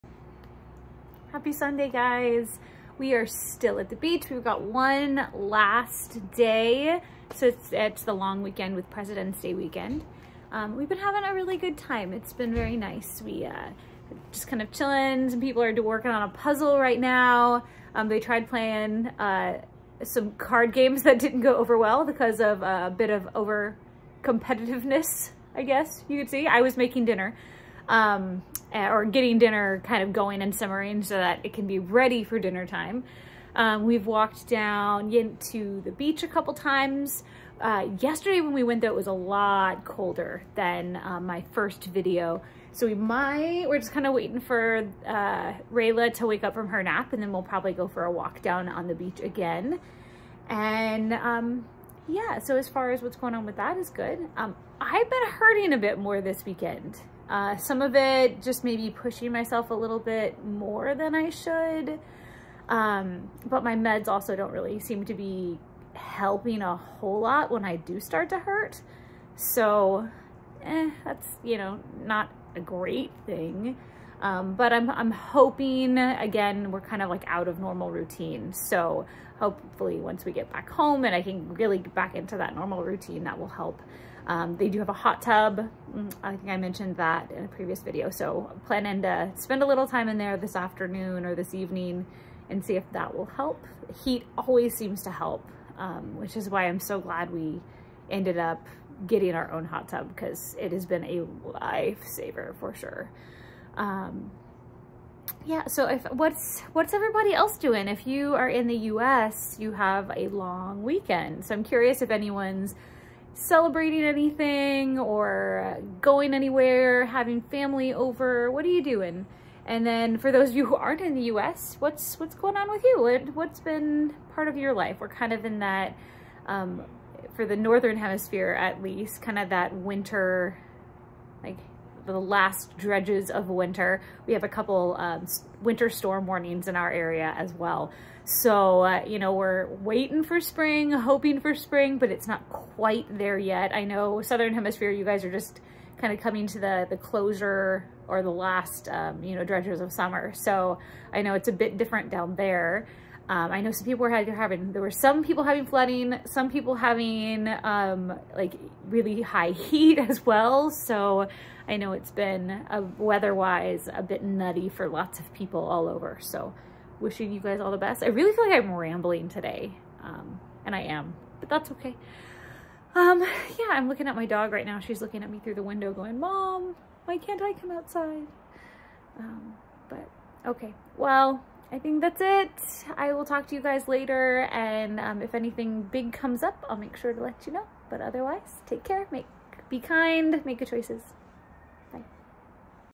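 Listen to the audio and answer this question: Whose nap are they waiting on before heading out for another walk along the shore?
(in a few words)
Rayla.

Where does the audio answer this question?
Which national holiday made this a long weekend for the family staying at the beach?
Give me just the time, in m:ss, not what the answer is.
0:08.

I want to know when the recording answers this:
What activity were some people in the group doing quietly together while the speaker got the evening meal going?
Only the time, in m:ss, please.
0:16.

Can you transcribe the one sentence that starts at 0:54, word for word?
Um, I've been hurting a bit more this weekend.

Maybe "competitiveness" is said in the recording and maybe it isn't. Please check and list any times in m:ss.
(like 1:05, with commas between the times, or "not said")
0:24.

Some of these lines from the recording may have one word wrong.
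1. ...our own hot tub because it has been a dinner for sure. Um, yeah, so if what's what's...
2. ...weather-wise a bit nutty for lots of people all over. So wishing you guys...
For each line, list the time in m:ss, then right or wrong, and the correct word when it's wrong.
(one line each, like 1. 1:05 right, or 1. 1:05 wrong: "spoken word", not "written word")
1. 1:39 wrong: "lifesaver", not "dinner"
2. 2:42 right.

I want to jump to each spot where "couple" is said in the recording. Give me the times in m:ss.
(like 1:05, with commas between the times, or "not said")
0:36, 2:14.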